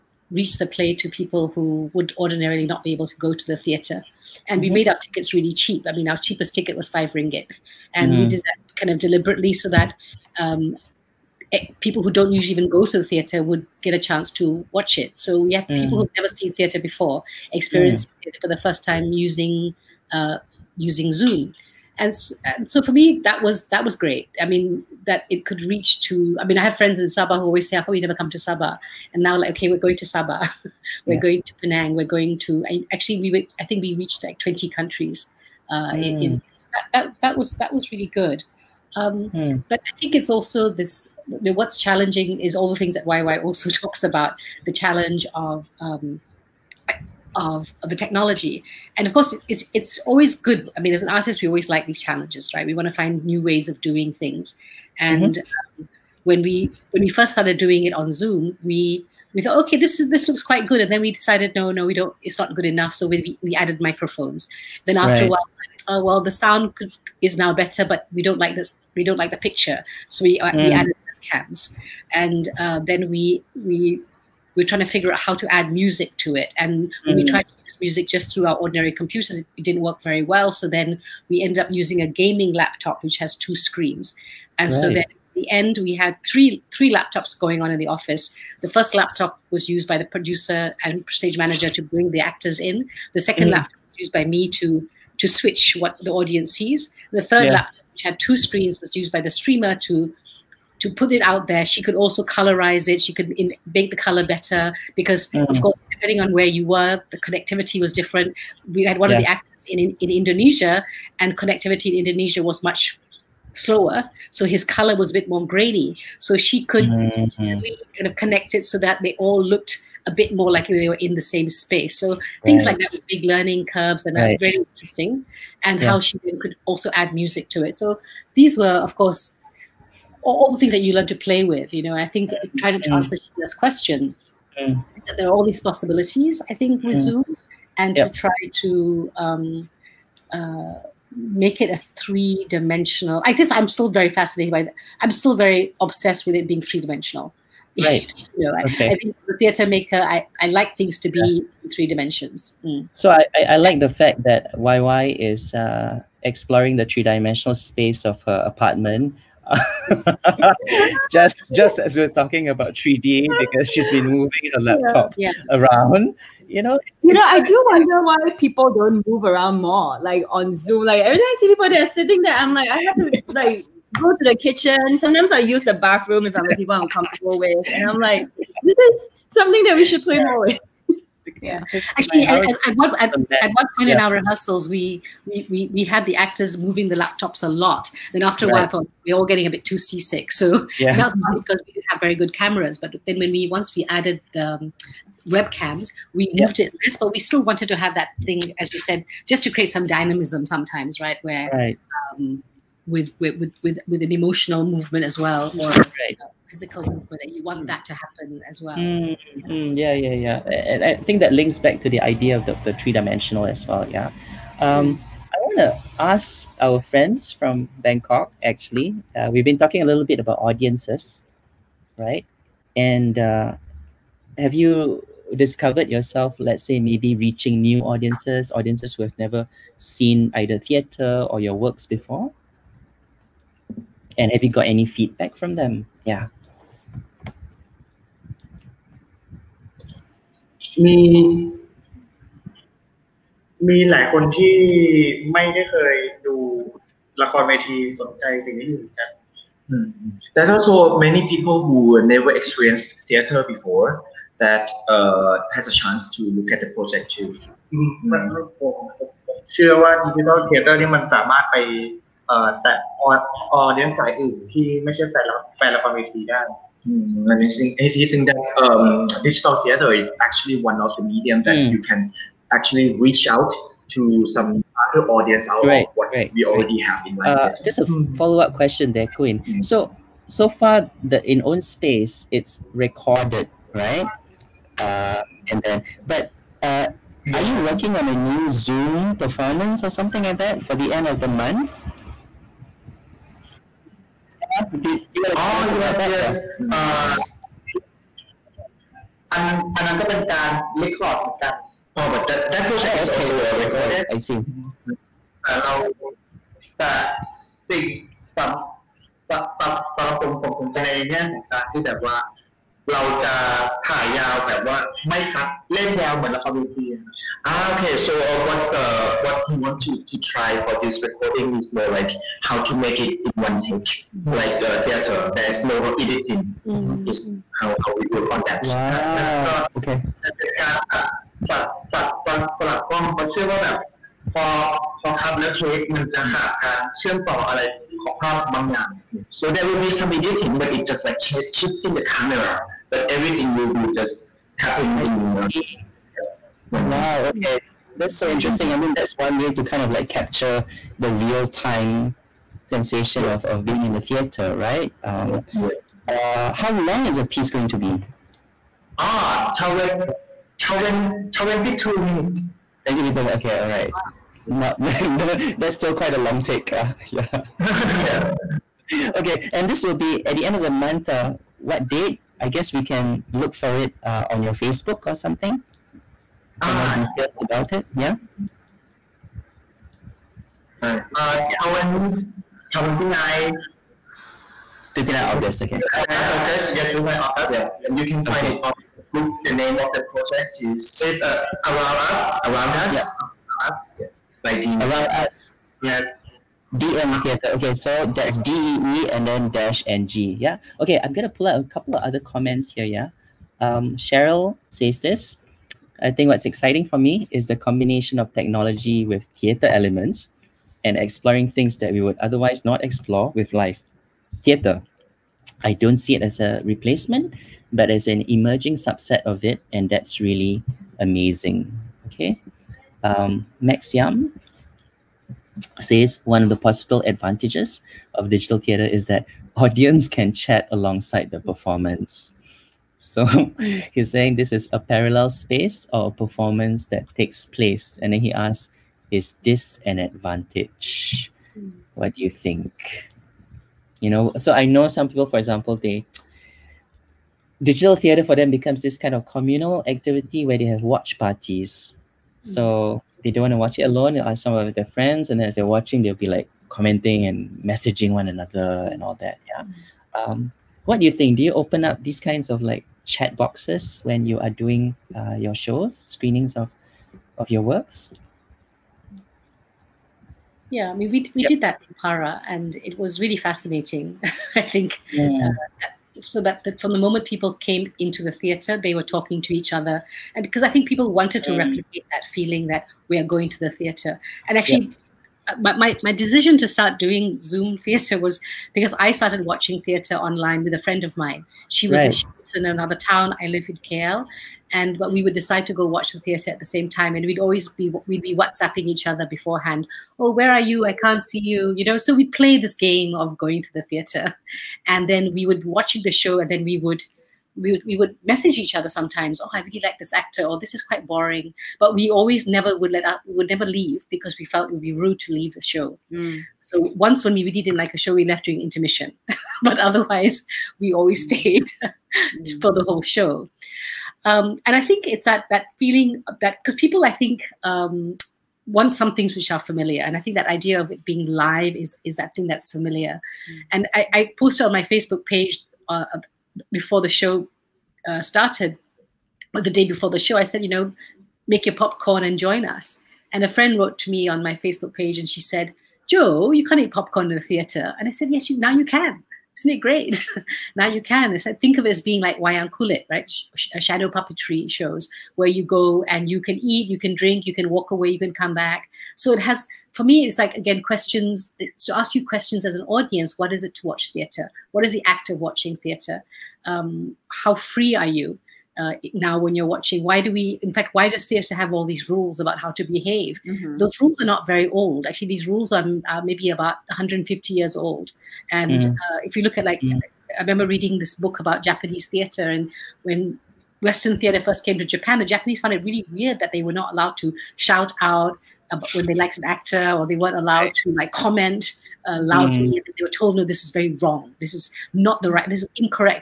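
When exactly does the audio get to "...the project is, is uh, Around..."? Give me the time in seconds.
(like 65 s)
389 s.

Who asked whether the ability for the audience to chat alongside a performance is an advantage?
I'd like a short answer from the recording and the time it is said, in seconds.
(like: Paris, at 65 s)
Max Yam, at 423 s.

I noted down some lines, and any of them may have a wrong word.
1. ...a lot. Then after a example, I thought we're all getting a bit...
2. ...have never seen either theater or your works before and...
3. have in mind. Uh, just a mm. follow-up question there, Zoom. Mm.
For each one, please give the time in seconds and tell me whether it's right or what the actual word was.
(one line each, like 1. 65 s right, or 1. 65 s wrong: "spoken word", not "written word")
1. 187 s wrong: "while", not "example"
2. 229 s right
3. 276 s wrong: "Queen", not "Zoom".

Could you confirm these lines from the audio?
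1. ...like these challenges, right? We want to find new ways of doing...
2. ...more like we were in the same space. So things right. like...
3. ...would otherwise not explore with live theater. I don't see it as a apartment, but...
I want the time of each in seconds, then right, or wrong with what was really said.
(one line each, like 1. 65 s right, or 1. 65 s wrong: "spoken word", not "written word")
1. 51 s right
2. 120 s right
3. 412 s wrong: "replacement", not "apartment".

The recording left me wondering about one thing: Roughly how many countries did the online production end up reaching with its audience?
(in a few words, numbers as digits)
20.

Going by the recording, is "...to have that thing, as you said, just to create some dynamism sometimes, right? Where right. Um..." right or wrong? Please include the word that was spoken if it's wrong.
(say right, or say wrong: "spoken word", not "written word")
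right.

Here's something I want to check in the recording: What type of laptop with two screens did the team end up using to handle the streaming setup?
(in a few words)
gaming laptop.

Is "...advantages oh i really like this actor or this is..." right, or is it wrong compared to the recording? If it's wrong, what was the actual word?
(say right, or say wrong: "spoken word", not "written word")
wrong: "sometimes", not "advantages".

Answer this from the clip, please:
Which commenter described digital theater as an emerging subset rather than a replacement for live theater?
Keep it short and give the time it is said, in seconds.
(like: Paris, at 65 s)
Cheryl, at 403 s.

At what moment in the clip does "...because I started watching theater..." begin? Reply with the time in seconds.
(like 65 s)
488 s.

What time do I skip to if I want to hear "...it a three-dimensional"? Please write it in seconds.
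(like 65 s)
141 s.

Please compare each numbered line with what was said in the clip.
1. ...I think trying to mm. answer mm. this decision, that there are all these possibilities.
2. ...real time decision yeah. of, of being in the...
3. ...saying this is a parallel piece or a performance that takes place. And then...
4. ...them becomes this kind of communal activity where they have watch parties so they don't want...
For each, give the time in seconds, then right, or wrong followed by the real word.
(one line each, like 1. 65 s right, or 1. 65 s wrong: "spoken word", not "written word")
1. 131 s wrong: "question", not "decision"
2. 351 s wrong: "sensation", not "decision"
3. 434 s wrong: "space", not "piece"
4. 448 s right.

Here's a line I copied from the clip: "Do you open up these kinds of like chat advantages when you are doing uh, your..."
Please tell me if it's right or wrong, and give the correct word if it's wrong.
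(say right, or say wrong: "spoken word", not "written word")
wrong: "boxes", not "advantages".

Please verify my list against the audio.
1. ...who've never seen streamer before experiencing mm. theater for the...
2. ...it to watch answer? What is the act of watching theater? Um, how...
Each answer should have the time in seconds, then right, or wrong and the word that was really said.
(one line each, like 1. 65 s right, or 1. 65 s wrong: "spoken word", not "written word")
1. 15 s wrong: "theater", not "streamer"
2. 563 s wrong: "theater", not "answer".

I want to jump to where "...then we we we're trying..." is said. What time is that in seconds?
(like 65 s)
72 s.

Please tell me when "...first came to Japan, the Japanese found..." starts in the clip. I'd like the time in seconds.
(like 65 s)
584 s.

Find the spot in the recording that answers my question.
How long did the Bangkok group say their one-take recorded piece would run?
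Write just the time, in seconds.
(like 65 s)
361 s.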